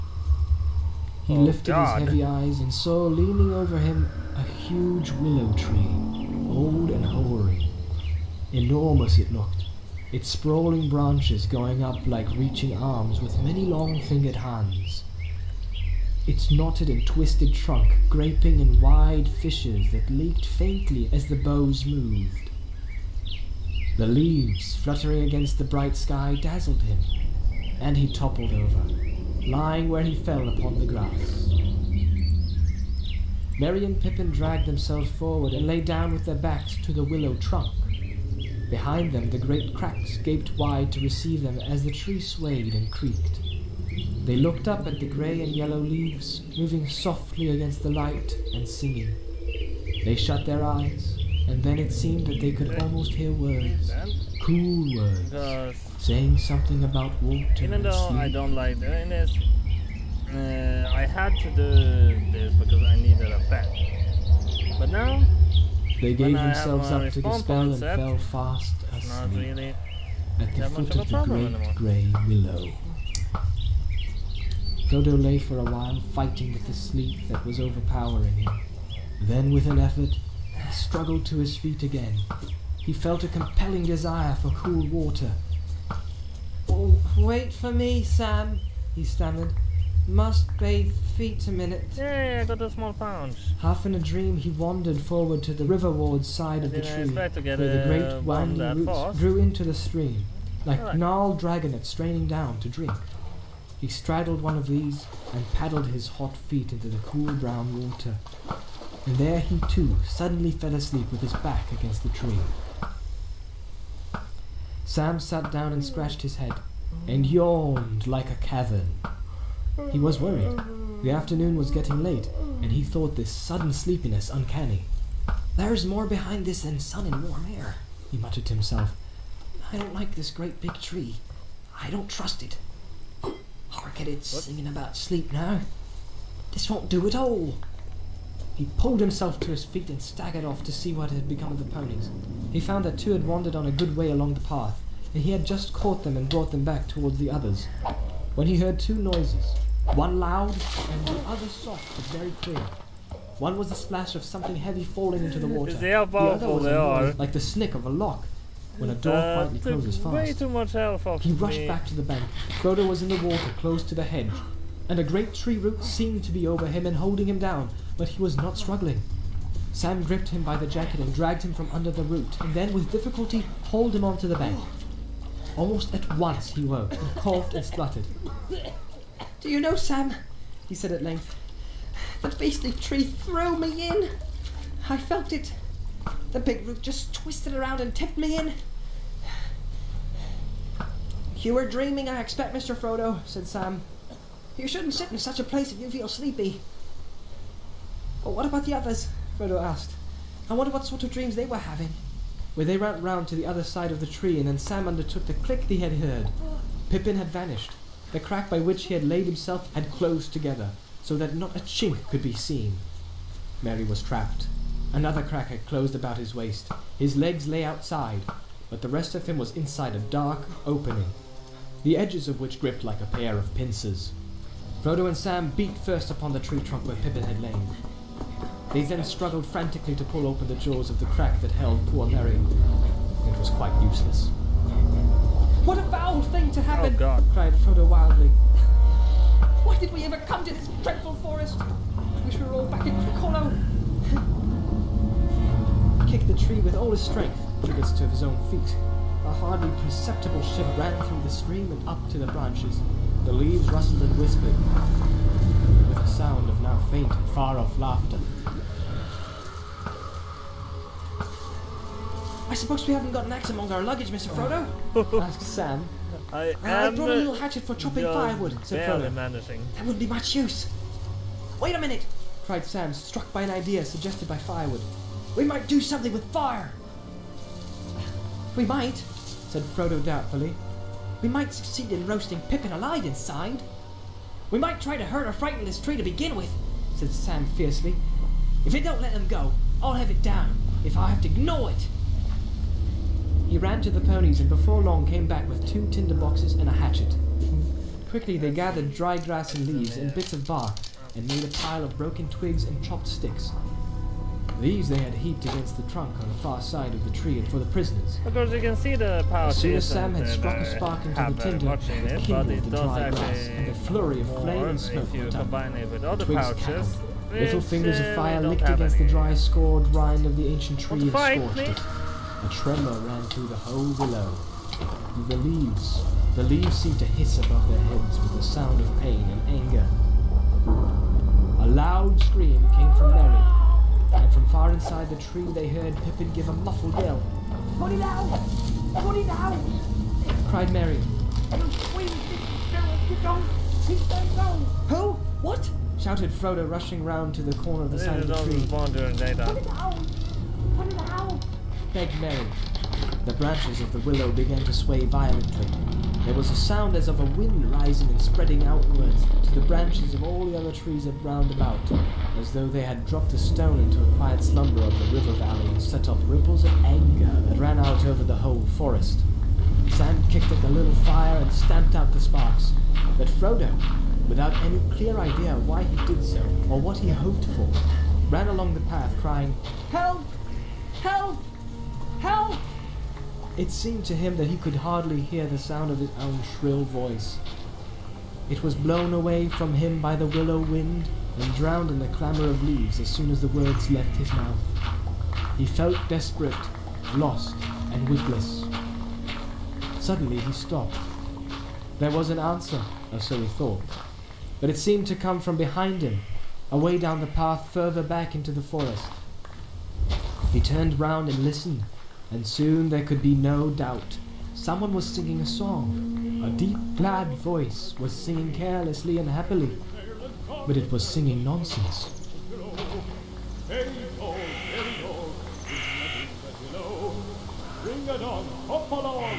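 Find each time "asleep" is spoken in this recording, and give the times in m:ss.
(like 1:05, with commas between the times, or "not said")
1:08, 1:50.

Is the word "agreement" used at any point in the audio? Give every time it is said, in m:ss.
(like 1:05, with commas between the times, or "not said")
not said.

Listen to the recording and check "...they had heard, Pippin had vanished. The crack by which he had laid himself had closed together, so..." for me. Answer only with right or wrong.
right.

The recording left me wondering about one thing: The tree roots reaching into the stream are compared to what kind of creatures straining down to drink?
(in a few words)
Dragonets.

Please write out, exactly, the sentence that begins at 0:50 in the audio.
They shut their eyes, and then it seemed that they could almost hear words, cool words, saying something about water.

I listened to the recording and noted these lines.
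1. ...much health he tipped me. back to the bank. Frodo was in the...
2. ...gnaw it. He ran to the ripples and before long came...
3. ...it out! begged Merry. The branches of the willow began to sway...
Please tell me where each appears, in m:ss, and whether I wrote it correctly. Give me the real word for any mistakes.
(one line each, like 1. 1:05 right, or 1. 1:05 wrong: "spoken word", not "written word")
1. 2:40 wrong: "rushed", not "tipped"
2. 4:51 wrong: "ponies", not "ripples"
3. 5:50 right.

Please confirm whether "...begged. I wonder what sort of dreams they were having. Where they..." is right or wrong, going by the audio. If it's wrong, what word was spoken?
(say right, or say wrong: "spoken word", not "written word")
wrong: "asked", not "begged".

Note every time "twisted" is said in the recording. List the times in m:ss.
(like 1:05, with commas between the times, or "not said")
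0:17, 3:07.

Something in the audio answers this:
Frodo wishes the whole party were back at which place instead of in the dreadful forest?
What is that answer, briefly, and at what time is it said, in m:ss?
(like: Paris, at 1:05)
Crickhollow, at 4:02.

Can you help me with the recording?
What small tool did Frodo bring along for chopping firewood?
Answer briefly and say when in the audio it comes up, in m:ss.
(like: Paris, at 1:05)
A little hatchet, at 4:27.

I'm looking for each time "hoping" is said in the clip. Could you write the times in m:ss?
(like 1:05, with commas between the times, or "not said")
not said.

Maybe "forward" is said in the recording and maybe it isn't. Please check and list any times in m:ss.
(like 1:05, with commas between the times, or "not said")
0:35, 1:34.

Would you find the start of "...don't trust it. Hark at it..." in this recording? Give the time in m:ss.
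2:11.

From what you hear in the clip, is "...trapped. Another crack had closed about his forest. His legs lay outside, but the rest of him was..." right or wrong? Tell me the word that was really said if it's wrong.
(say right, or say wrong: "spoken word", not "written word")
wrong: "waist", not "forest".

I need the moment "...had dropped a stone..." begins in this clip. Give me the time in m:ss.
6:02.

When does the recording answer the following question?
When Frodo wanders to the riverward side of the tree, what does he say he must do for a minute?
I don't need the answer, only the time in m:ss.
1:30.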